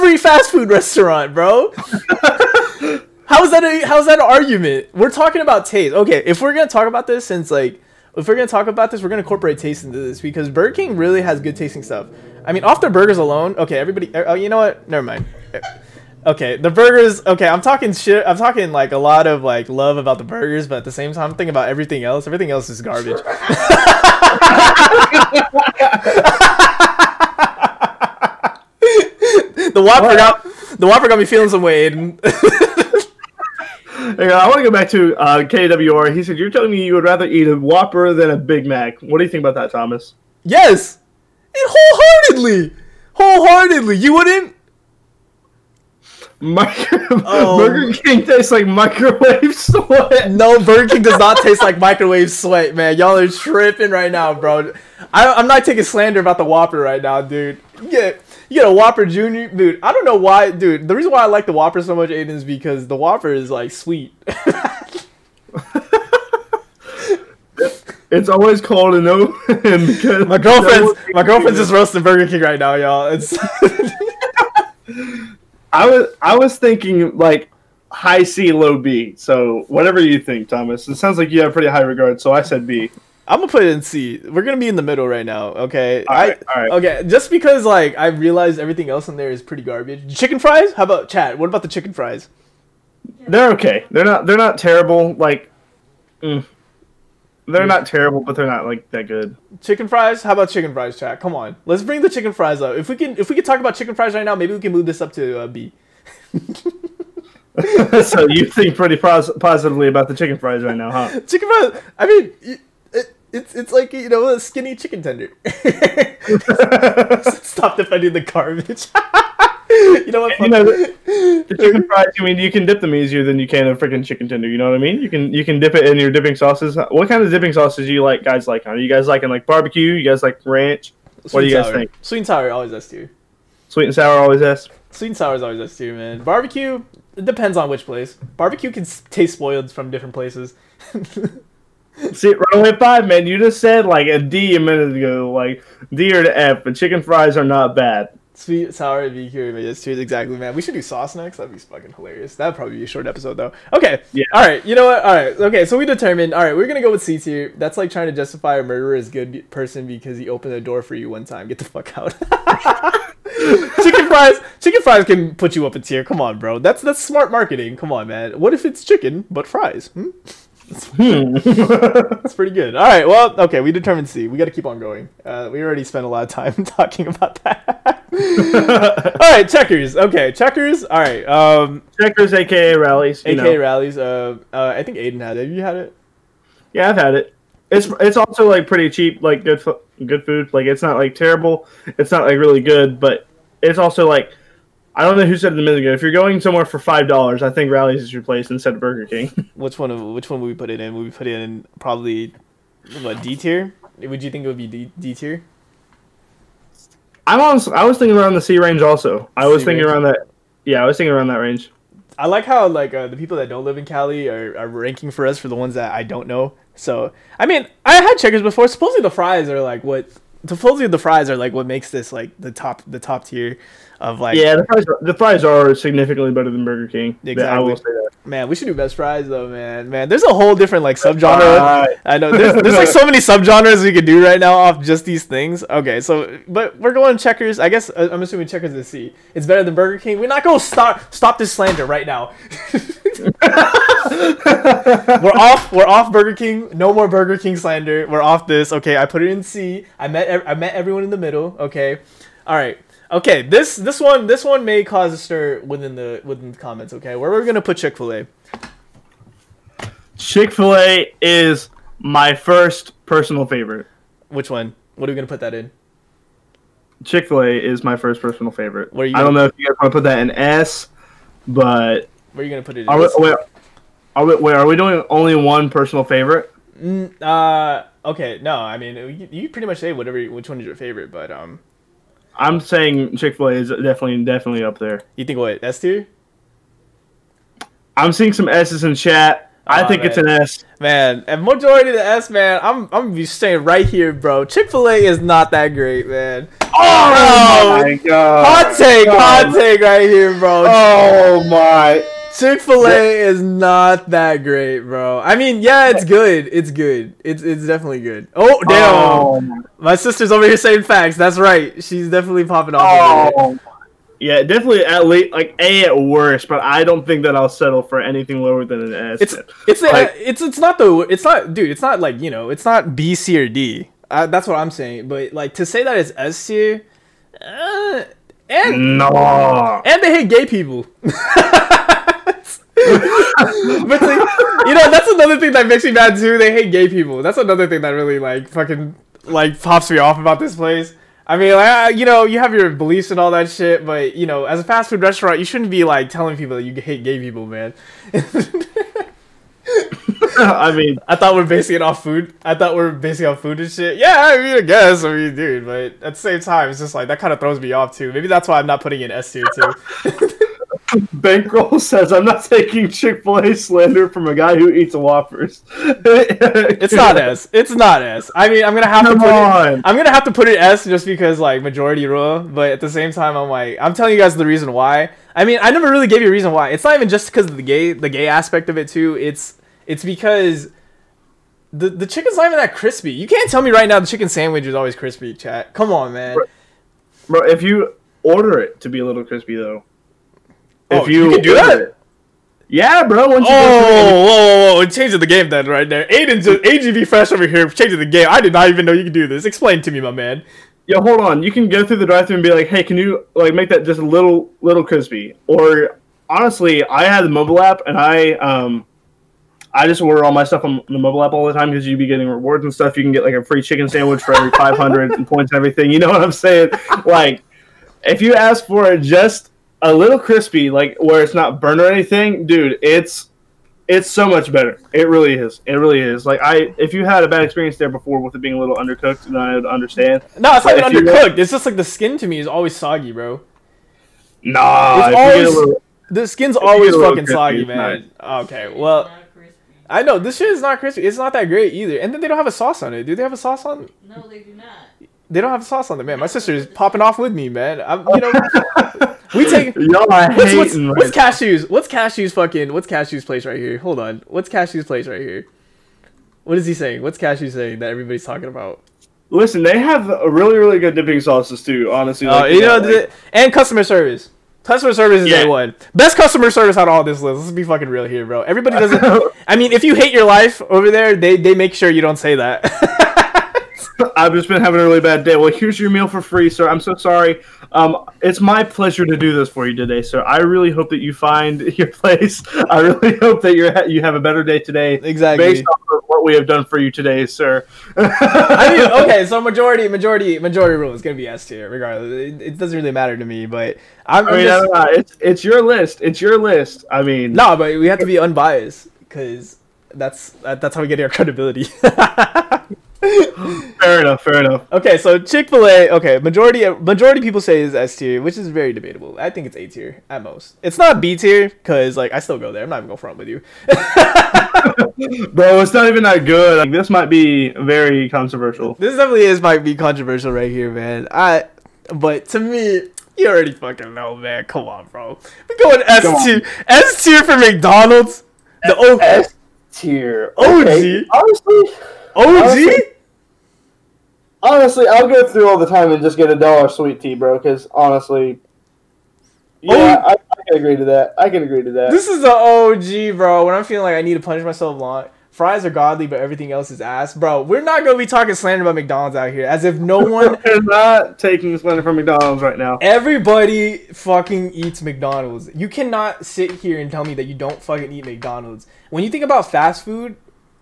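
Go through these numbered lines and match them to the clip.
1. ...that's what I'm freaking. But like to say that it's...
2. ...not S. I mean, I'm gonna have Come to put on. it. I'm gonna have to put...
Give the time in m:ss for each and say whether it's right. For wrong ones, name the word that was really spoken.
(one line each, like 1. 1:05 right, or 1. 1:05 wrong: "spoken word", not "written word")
1. 5:24 wrong: "saying", not "freaking"
2. 6:07 right.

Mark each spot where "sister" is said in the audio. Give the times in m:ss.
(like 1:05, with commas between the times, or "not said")
5:09, 7:26.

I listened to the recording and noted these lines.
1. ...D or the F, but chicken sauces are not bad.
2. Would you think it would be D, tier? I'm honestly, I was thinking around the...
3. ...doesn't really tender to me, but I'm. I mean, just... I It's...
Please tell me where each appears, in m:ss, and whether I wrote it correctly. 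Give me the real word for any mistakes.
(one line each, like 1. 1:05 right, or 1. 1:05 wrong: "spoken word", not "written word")
1. 2:25 wrong: "fries", not "sauces"
2. 3:23 right
3. 8:12 wrong: "matter", not "tender".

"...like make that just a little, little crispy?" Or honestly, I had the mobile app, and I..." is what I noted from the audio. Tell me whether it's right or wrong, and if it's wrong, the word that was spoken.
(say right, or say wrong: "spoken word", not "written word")
right.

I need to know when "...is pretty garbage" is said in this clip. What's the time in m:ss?
1:29.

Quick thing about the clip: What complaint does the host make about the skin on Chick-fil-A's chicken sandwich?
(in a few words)
Always soggy.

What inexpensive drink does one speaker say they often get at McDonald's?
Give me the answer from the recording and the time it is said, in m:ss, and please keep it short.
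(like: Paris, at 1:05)
Dollar sweet tea, at 8:56.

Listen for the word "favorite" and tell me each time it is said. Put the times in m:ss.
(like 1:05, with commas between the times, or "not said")
4:23, 4:28, 4:36, 4:40.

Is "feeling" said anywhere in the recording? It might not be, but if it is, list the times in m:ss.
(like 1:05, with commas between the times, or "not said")
0:31, 9:03.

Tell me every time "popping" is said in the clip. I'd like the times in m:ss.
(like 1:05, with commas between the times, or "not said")
5:12, 7:26.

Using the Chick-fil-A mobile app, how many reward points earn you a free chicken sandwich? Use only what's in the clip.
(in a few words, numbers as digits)
500.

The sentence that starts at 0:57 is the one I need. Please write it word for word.
Get you get a Whopper Junior, dude.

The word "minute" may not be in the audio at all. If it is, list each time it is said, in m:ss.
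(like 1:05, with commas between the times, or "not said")
2:24, 3:15.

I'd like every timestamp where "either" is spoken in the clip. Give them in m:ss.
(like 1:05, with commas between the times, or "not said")
7:21.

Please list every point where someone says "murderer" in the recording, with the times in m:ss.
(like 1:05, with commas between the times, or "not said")
2:38.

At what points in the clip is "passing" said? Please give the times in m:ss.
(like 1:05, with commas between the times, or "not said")
not said.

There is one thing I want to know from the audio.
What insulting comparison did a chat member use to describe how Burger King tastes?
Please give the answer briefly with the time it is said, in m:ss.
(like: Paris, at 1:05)
Microwave sweat, at 0:47.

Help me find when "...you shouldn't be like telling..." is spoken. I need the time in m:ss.
5:45.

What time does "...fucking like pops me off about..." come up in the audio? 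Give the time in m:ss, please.
5:38.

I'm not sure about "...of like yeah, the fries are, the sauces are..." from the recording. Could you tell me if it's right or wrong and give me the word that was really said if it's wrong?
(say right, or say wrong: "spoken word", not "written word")
wrong: "fries", not "sauces".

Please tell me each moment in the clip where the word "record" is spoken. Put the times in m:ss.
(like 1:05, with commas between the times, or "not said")
not said.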